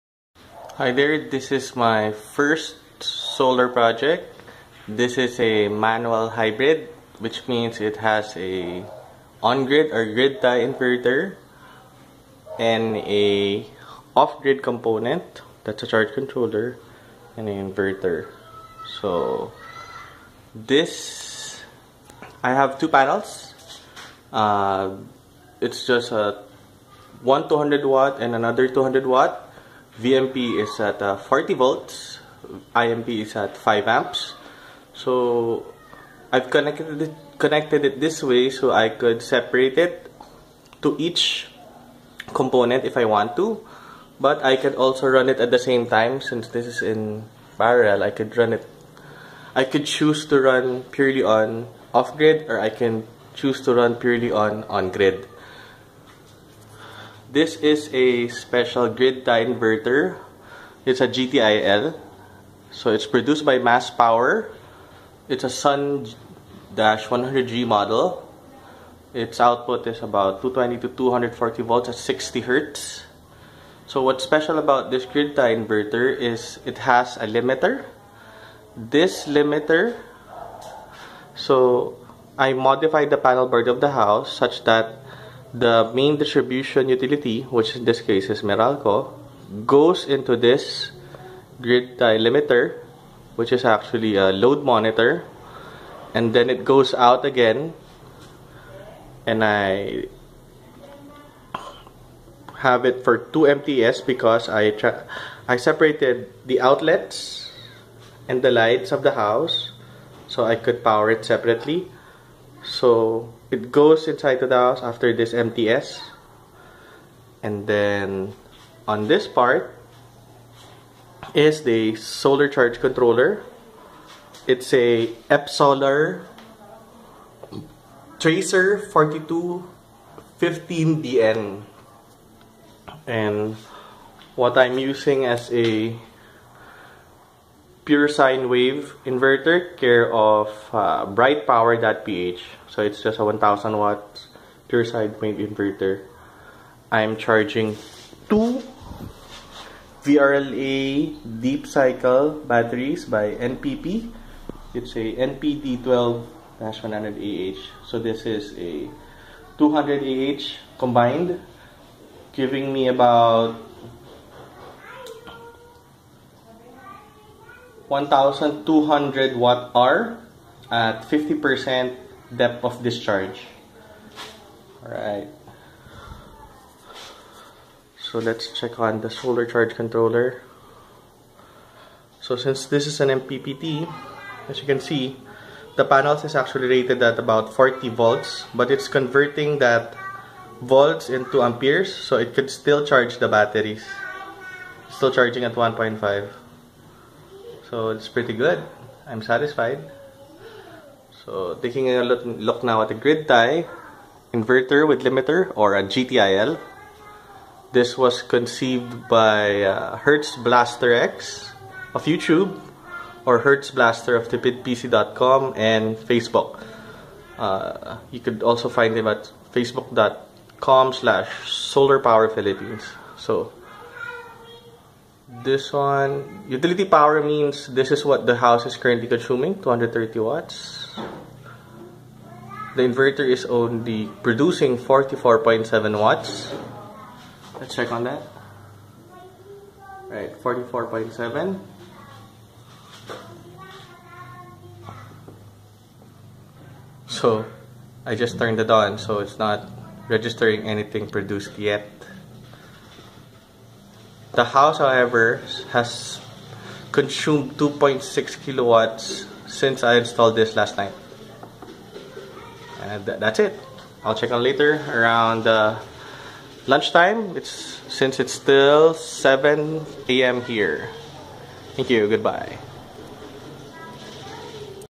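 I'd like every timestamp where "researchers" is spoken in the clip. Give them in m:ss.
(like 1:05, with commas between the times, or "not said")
not said.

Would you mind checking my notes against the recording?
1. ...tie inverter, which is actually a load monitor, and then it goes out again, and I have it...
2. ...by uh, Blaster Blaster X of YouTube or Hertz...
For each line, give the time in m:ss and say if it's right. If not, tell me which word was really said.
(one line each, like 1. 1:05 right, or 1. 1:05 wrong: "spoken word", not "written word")
1. 1:31 wrong: "limiter", not "inverter"
2. 3:29 wrong: "Hertz", not "Blaster".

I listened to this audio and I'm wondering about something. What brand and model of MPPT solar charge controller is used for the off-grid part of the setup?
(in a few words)
Epsolar Tracer 4215BN.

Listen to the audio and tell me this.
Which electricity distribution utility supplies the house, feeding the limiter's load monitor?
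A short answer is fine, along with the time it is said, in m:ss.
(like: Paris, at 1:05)
Meralco, at 1:28.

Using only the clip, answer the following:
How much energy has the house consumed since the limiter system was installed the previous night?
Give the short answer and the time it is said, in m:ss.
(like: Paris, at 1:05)
2.6 kilowatts, at 4:17.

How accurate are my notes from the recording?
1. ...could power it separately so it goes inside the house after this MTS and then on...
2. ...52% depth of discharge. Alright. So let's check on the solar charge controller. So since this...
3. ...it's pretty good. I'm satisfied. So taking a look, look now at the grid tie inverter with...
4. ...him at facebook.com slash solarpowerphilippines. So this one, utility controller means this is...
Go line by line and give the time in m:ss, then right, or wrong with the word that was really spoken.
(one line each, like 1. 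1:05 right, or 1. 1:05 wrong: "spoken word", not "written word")
1. 1:50 right
2. 2:51 wrong: "50", not "52"
3. 3:17 right
4. 3:38 wrong: "power", not "controller".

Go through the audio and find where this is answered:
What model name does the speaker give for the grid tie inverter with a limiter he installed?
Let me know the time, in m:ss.
1:05.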